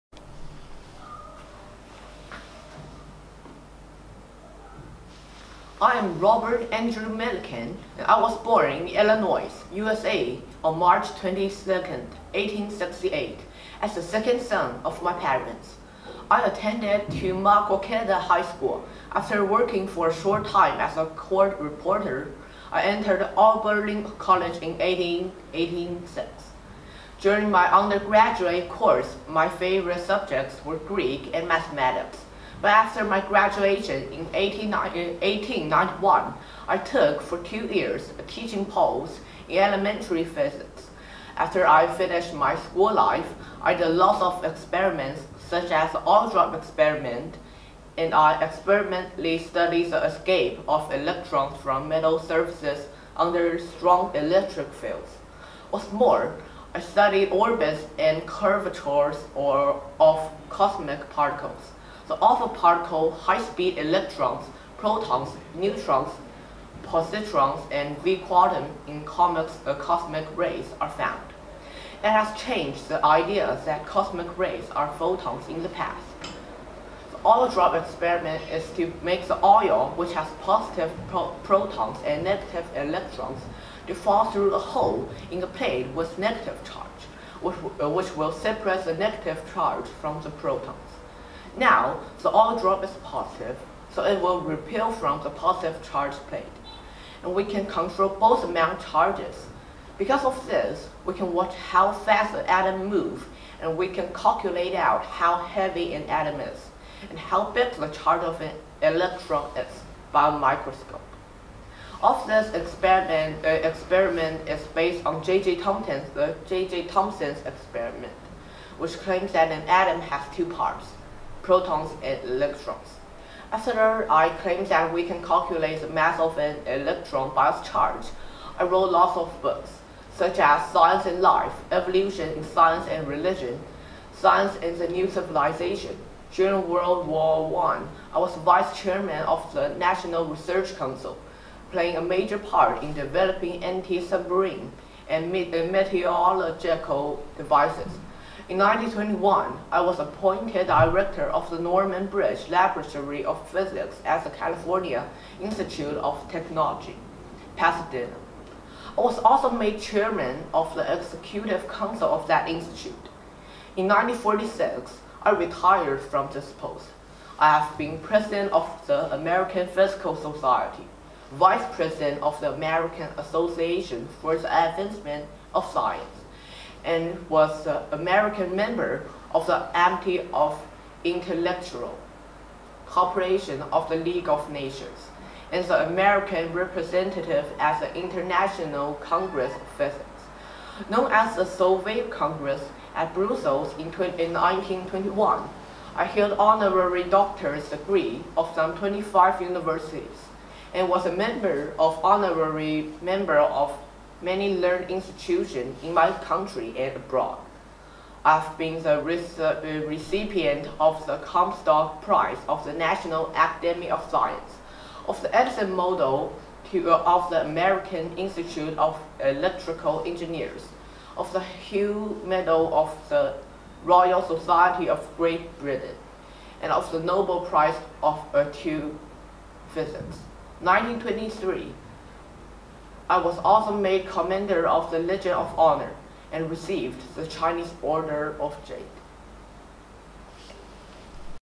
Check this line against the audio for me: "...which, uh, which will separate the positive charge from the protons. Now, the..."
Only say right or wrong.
wrong.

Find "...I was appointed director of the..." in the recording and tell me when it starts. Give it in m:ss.
2:29.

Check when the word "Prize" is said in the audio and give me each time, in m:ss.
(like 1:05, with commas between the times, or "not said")
3:32, 3:47.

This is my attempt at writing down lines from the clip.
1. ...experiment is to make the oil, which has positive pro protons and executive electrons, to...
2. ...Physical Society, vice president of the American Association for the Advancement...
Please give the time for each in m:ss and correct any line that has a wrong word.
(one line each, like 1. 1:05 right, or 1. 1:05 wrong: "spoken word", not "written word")
1. 1:17 wrong: "negative", not "executive"
2. 2:49 right.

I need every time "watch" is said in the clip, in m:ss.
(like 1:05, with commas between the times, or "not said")
1:41.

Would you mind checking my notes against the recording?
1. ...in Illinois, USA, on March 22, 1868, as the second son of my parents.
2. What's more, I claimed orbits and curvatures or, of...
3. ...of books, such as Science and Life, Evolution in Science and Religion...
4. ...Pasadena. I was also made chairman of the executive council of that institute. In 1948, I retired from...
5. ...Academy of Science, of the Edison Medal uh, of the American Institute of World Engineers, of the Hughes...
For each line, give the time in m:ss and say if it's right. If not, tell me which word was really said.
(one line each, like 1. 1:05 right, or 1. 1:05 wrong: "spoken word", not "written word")
1. 0:08 right
2. 0:55 wrong: "studied", not "claimed"
3. 2:09 right
4. 2:37 wrong: "1946", not "1948"
5. 3:33 wrong: "Electrical", not "World".